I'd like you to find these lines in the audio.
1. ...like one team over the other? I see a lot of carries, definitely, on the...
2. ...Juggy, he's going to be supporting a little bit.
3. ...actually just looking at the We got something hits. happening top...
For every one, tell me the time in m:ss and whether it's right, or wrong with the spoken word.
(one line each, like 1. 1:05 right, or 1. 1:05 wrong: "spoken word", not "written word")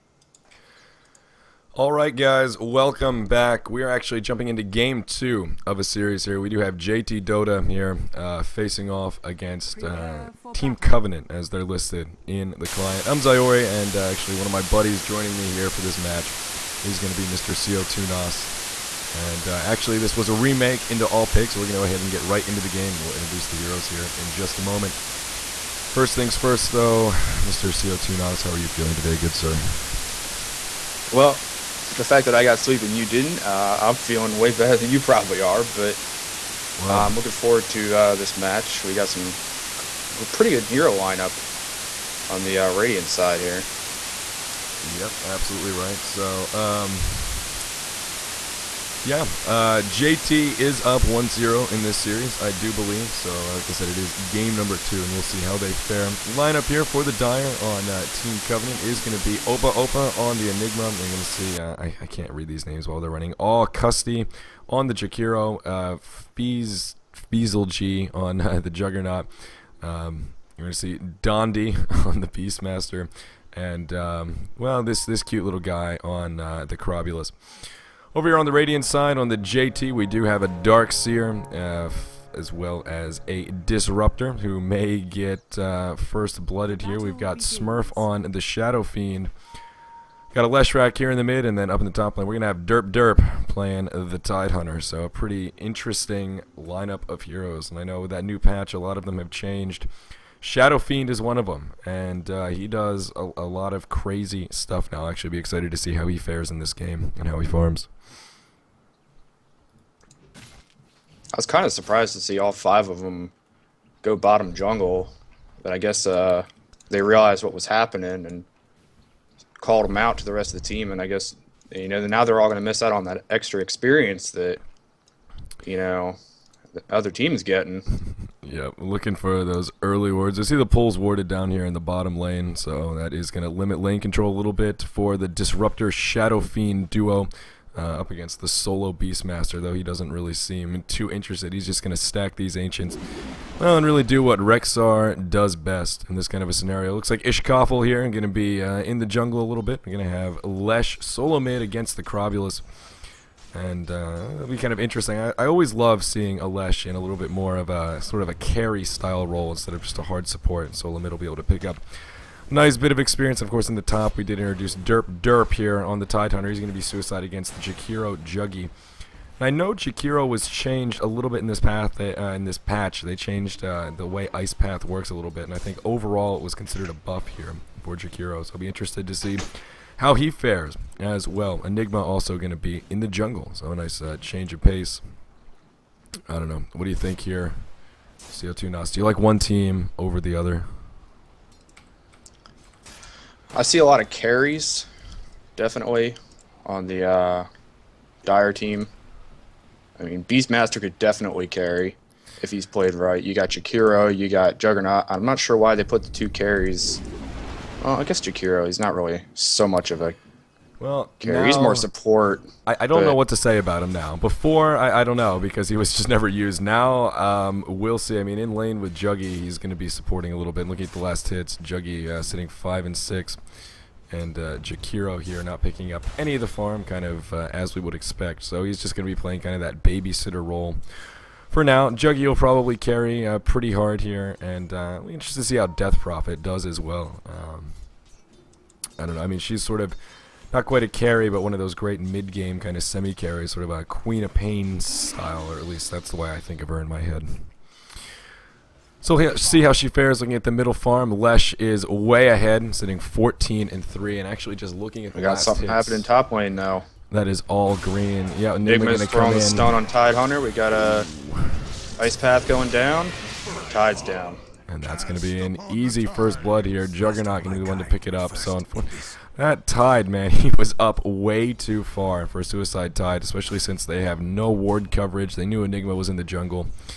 1. 3:09 right
2. 3:38 right
3. 4:14 right.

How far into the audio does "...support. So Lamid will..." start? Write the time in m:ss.
2:40.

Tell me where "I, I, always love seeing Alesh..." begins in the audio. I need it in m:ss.
2:35.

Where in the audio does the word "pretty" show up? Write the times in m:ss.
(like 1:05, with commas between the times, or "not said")
0:40, 1:35, 3:53.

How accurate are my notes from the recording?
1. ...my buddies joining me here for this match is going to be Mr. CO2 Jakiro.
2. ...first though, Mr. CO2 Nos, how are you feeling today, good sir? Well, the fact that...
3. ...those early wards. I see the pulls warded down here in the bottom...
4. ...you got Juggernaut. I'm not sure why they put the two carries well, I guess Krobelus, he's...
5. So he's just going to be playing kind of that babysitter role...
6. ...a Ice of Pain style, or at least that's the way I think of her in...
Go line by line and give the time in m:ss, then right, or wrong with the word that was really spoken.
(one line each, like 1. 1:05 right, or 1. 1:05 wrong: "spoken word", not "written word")
1. 0:14 wrong: "Nos", not "Jakiro"
2. 0:26 right
3. 2:09 right
4. 3:24 wrong: "Jakiro", not "Krobelus"
5. 3:48 right
6. 4:03 wrong: "Queen", not "Ice".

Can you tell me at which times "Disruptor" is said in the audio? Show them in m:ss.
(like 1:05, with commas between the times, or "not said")
1:23, 2:15.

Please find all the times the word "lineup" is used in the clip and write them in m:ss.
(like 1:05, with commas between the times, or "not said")
0:40, 0:56, 1:36.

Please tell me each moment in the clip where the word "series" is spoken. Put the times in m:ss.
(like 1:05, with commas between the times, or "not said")
0:05, 0:51.